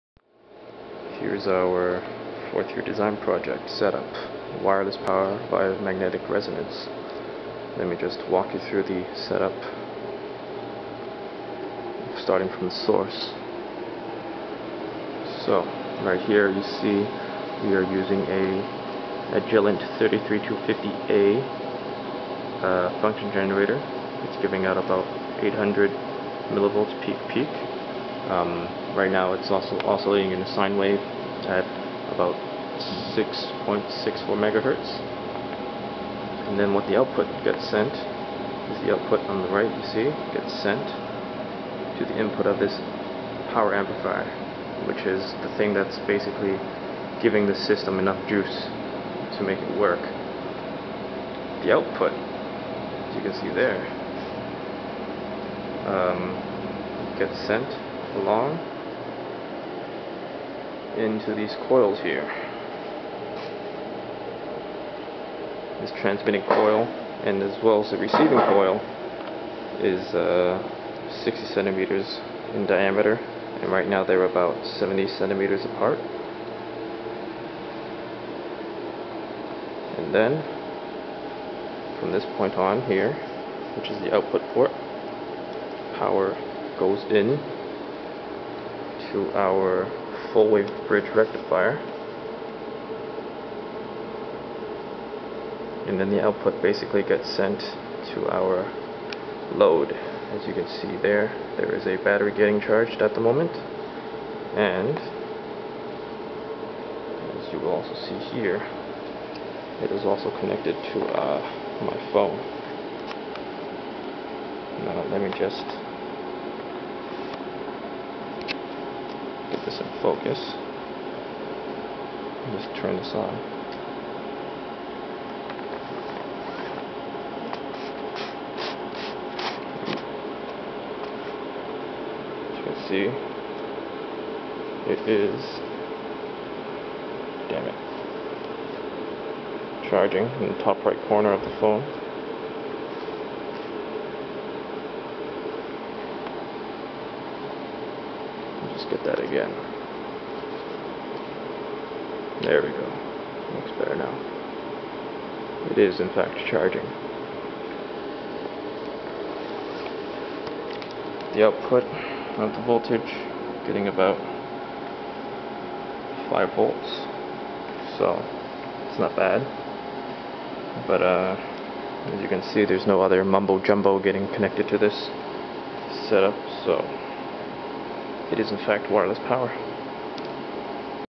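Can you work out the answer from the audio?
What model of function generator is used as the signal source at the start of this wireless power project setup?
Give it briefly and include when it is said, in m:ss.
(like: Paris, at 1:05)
Agilent 33250A, at 0:19.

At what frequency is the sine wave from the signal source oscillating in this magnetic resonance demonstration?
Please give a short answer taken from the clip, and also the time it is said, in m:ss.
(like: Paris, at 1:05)
6.64 MHz, at 0:33.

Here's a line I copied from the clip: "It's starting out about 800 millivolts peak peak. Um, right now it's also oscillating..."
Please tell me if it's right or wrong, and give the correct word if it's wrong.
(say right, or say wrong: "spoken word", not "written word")
wrong: "giving", not "starting".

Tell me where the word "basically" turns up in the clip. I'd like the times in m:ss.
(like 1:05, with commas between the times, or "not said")
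0:46, 1:36.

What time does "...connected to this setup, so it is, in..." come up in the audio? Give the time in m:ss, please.
2:54.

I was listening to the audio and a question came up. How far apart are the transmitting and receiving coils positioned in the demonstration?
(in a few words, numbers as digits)
70 centimeters.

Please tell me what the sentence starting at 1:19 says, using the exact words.
And then from this point on here, which is the output port, power goes in to our full wave bridge rectifier.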